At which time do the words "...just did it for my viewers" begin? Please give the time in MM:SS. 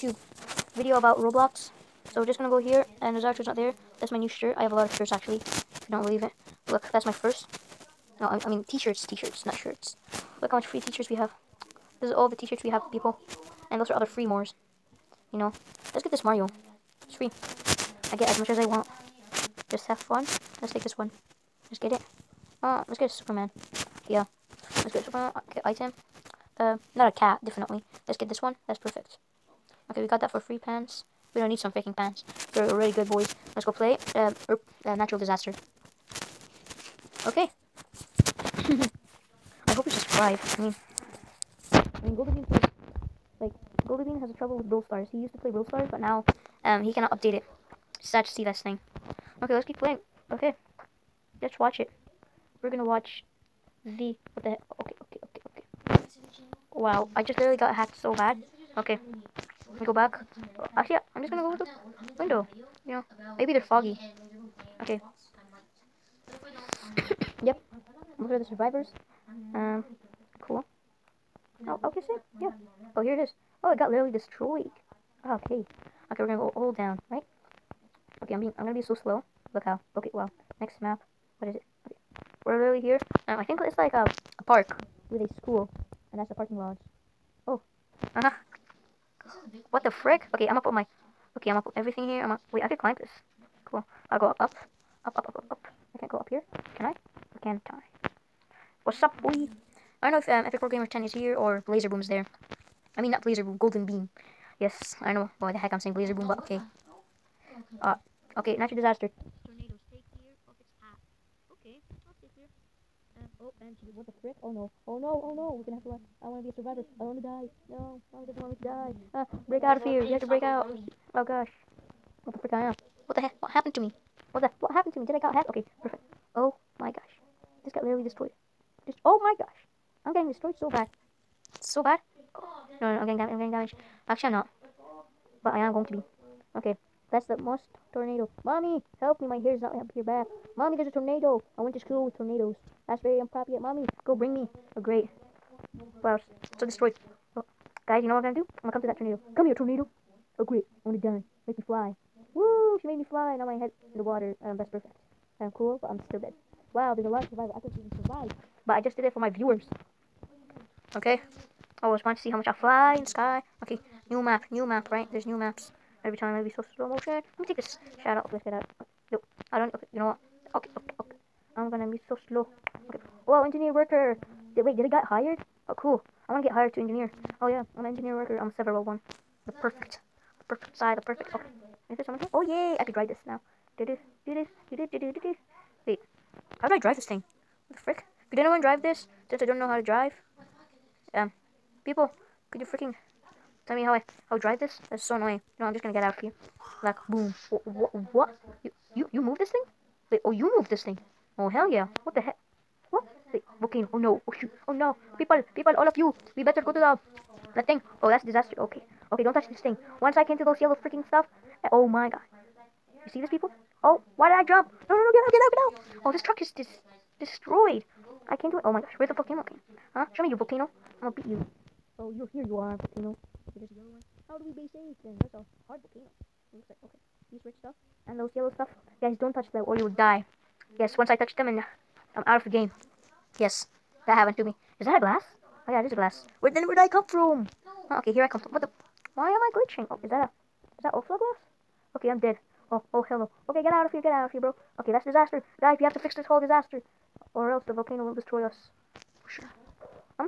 02:38.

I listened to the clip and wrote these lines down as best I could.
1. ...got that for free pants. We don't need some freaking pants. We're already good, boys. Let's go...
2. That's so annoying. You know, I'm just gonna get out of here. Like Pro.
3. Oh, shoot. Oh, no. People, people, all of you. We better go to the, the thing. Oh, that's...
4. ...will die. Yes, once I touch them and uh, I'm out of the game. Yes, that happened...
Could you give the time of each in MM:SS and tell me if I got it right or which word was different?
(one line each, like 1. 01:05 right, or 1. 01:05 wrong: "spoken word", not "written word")
1. 00:30 right
2. 03:14 wrong: "Boom", not "Pro"
3. 03:24 right
4. 03:49 right.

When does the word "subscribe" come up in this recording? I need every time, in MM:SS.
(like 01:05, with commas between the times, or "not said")
00:39.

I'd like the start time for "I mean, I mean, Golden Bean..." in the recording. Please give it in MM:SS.
00:40.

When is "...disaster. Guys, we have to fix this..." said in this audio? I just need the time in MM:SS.
04:05.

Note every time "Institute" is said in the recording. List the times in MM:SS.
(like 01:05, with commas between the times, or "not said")
not said.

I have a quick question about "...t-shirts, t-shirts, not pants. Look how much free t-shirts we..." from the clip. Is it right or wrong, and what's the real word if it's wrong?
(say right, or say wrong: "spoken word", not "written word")
wrong: "shirts", not "pants".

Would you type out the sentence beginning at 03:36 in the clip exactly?
Oh, this truck is dis destroyed.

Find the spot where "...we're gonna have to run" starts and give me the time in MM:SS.
01:55.